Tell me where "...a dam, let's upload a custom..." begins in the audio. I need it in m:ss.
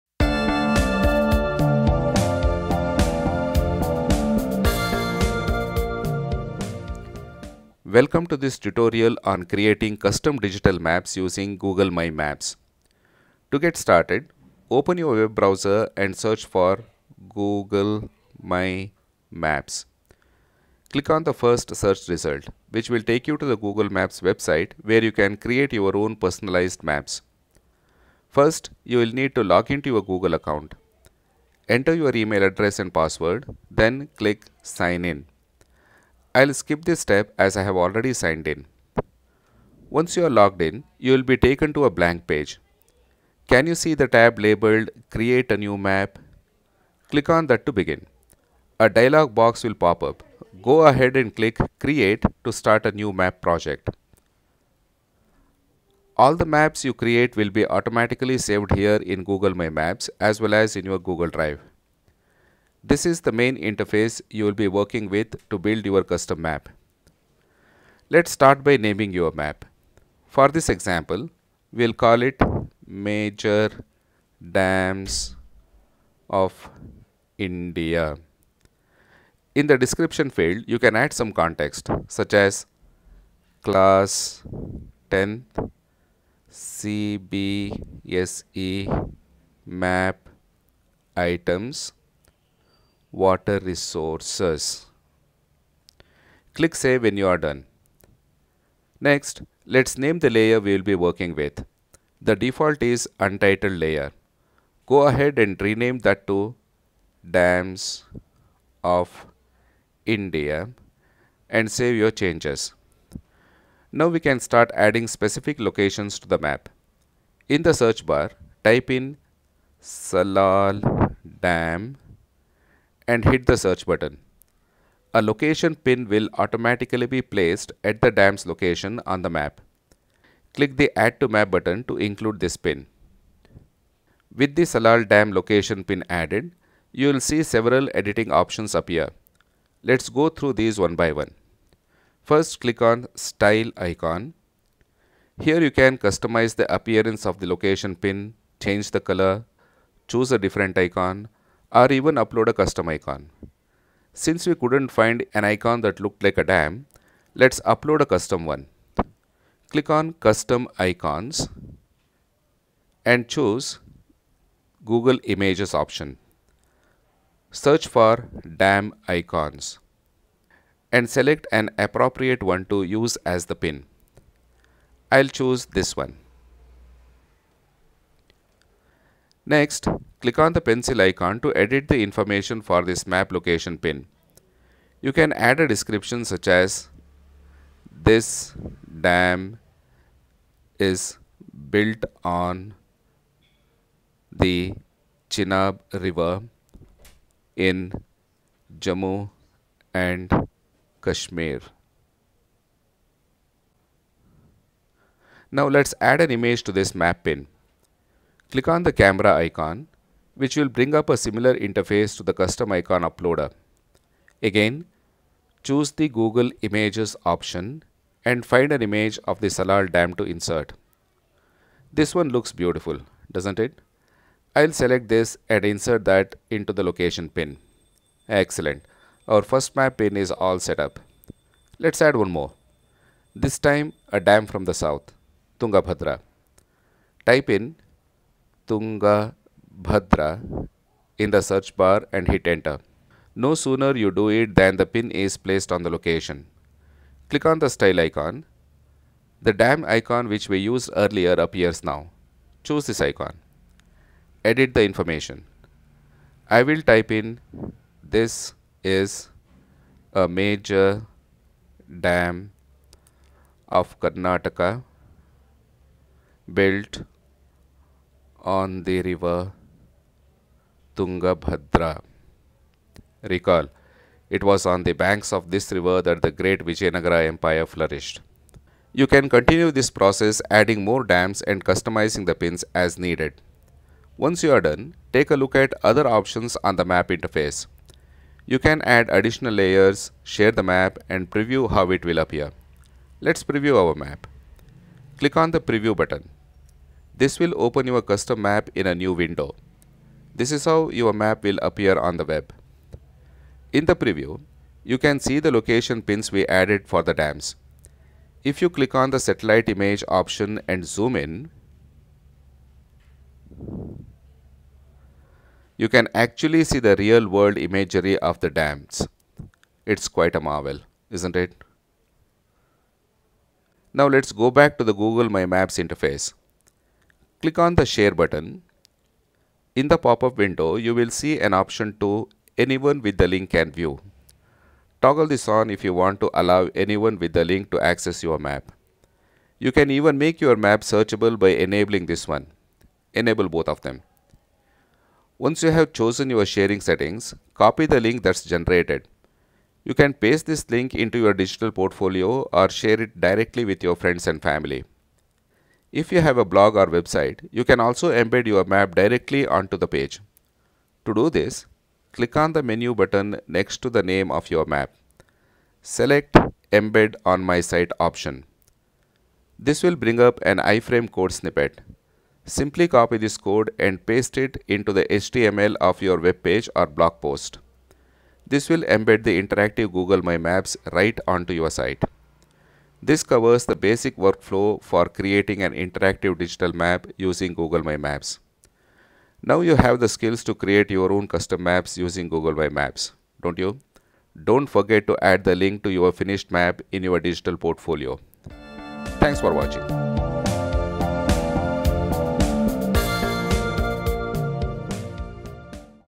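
2:36.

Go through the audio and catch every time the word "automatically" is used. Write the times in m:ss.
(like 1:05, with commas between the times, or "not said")
0:57, 2:06.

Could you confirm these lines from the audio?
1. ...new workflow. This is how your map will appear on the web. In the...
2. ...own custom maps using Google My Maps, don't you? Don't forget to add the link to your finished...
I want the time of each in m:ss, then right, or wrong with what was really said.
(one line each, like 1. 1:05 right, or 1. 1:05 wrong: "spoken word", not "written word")
1. 4:58 wrong: "window", not "workflow"
2. 6:31 right.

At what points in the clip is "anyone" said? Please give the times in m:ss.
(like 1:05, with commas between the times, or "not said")
5:32, 5:36.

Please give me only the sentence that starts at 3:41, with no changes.
This one looks beautiful, doesn't it?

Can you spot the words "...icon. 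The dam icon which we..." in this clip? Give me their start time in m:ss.
4:07.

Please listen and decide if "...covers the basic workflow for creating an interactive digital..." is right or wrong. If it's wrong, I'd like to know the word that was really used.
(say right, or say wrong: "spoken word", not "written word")
right.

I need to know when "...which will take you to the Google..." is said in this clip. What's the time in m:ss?
0:22.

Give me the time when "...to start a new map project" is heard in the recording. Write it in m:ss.
0:52.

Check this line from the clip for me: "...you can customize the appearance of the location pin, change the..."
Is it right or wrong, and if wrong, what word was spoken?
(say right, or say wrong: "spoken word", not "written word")
right.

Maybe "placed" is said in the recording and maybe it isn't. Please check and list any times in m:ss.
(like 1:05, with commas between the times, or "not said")
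2:07, 4:05.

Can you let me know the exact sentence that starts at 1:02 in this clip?
This is the main interface you will be working with to build your custom map.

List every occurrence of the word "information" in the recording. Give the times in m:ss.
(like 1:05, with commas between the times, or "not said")
3:02, 4:14.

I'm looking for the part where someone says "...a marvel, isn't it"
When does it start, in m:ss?
5:20.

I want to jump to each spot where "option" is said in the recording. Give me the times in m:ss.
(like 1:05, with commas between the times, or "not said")
2:18, 2:45, 3:37, 4:46, 5:10, 5:31, 6:07.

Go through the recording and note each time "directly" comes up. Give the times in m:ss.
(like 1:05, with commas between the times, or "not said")
5:53, 5:58.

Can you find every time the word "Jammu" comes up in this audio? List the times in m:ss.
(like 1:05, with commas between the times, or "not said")
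3:18.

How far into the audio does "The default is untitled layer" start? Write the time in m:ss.
1:42.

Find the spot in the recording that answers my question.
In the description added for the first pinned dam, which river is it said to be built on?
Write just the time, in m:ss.
3:15.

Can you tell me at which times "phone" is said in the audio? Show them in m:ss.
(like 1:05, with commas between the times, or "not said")
not said.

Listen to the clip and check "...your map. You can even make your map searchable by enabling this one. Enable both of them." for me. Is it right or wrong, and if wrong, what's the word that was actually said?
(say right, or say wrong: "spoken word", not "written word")
right.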